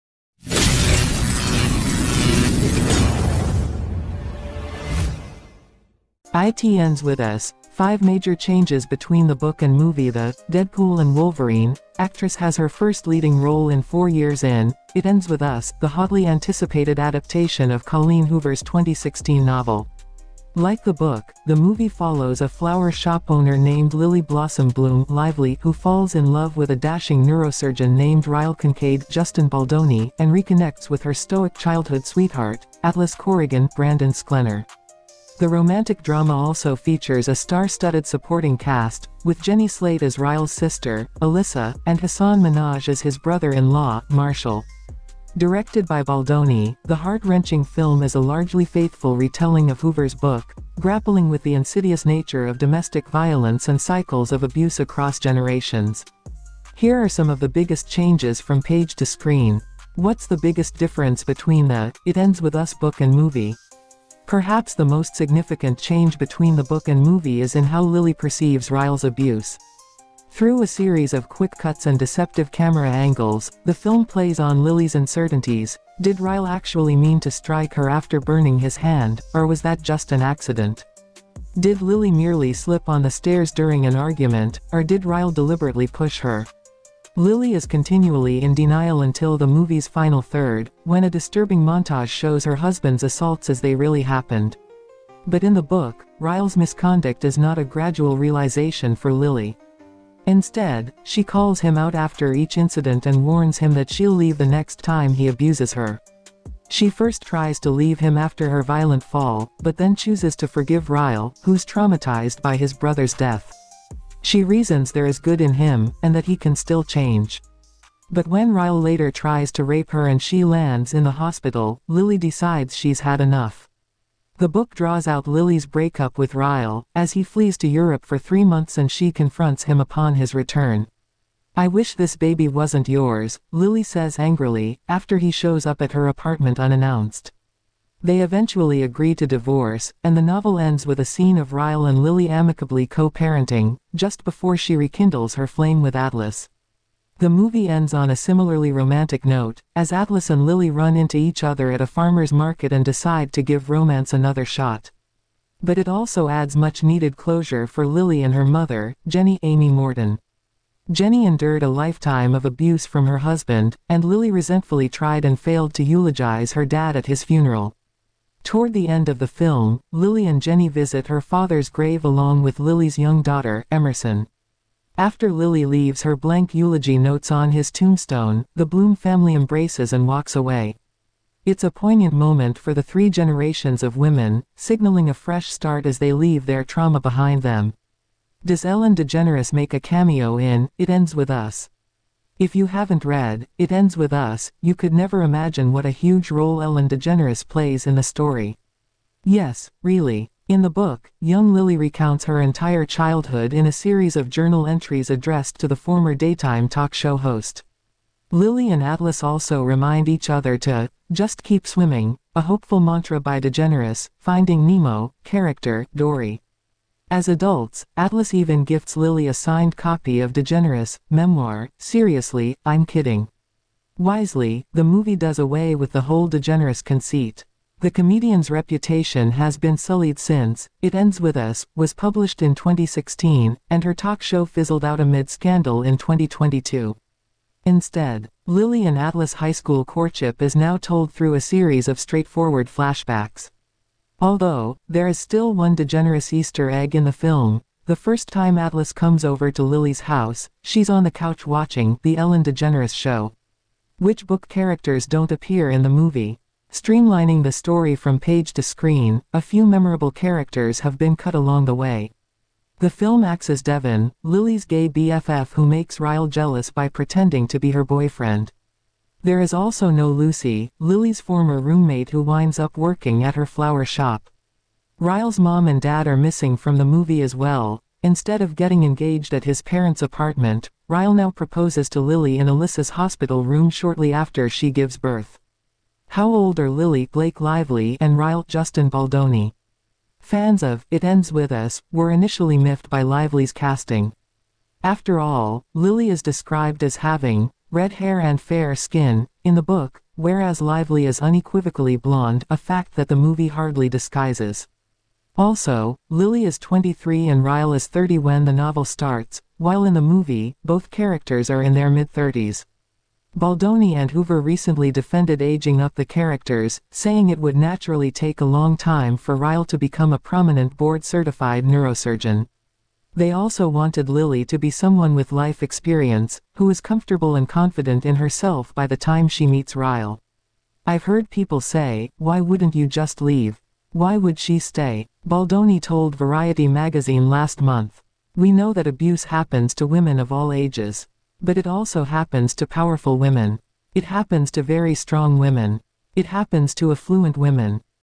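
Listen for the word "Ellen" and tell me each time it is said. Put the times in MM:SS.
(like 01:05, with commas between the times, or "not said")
03:08, 03:16, 04:12.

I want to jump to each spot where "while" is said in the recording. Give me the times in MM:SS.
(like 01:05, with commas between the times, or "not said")
05:09.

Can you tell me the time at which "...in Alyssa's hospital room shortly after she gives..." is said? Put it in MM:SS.
04:42.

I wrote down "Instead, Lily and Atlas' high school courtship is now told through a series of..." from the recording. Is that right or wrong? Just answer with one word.
right.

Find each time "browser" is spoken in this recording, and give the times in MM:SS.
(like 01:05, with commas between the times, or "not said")
not said.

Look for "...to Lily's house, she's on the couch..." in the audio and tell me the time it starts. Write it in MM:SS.
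04:09.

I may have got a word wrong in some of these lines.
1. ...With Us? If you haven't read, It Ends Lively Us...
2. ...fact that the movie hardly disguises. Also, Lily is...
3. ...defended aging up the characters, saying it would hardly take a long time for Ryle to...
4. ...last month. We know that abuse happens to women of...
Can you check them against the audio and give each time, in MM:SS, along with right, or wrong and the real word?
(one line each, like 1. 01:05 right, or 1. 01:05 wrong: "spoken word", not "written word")
1. 03:11 wrong: "With", not "Lively"
2. 05:02 right
3. 05:14 wrong: "naturally", not "hardly"
4. 05:37 right.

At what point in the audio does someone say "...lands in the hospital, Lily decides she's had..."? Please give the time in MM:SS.
02:00.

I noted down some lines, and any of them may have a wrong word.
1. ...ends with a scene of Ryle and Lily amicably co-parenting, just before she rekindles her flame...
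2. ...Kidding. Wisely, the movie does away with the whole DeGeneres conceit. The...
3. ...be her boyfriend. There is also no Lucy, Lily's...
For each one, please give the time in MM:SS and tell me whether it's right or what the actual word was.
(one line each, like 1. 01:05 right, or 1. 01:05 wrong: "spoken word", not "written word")
1. 02:20 right
2. 03:42 right
3. 04:27 right.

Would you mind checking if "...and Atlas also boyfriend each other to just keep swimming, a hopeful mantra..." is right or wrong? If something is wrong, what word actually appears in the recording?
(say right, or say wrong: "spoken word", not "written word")
wrong: "remind", not "boyfriend".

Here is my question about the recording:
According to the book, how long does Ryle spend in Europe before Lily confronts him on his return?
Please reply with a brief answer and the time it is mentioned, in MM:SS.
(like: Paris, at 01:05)
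3 months, at 02:08.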